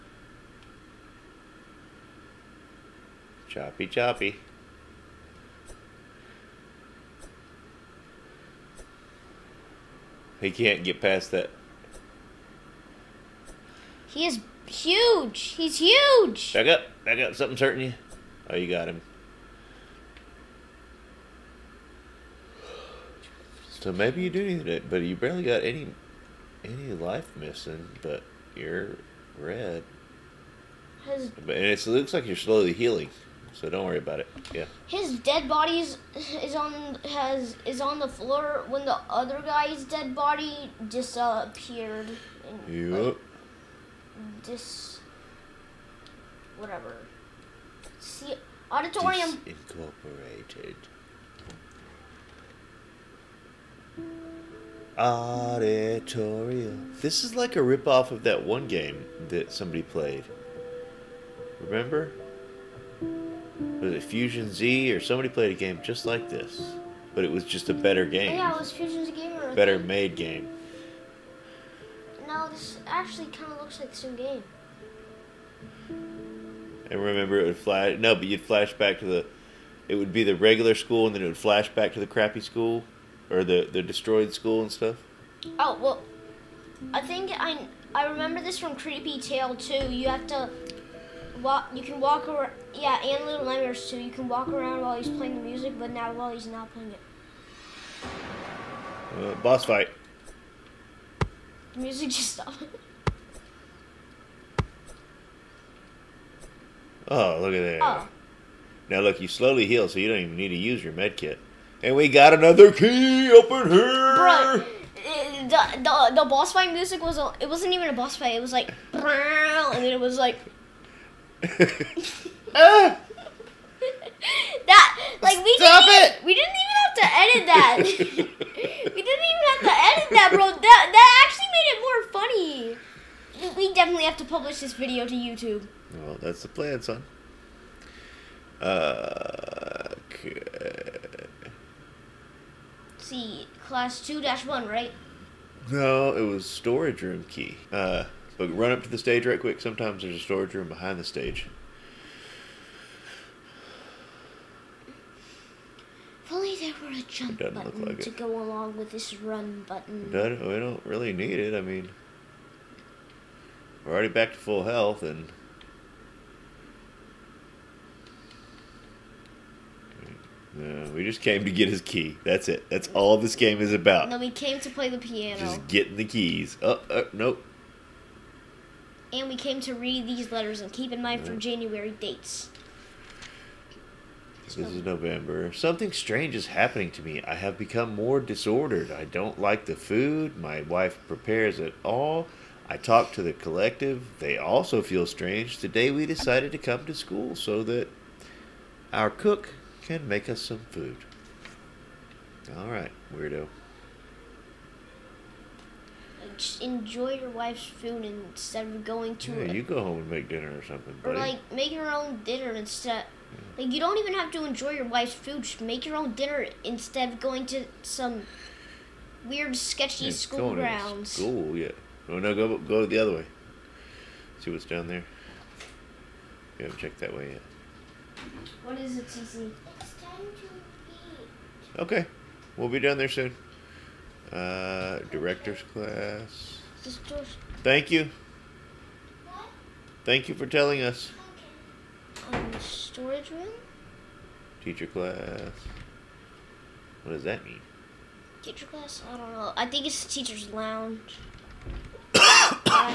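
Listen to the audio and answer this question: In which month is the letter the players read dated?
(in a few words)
November.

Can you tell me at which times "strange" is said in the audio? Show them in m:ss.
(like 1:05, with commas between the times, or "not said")
3:05, 3:15.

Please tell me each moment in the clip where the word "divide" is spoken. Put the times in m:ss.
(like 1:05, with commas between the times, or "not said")
not said.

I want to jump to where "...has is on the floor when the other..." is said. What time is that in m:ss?
0:37.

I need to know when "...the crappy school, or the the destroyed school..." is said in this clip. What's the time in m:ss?
1:21.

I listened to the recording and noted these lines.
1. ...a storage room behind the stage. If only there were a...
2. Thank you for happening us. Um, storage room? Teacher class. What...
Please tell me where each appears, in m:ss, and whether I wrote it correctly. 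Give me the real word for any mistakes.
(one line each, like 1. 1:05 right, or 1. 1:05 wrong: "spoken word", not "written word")
1. 2:30 right
2. 4:00 wrong: "telling", not "happening".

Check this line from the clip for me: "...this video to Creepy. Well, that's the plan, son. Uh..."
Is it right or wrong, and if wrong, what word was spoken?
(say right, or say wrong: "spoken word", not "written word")
wrong: "YouTube", not "Creepy".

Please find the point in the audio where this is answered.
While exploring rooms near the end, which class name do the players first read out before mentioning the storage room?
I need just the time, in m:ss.
3:55.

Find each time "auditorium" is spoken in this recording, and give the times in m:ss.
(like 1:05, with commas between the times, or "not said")
0:48, 0:54.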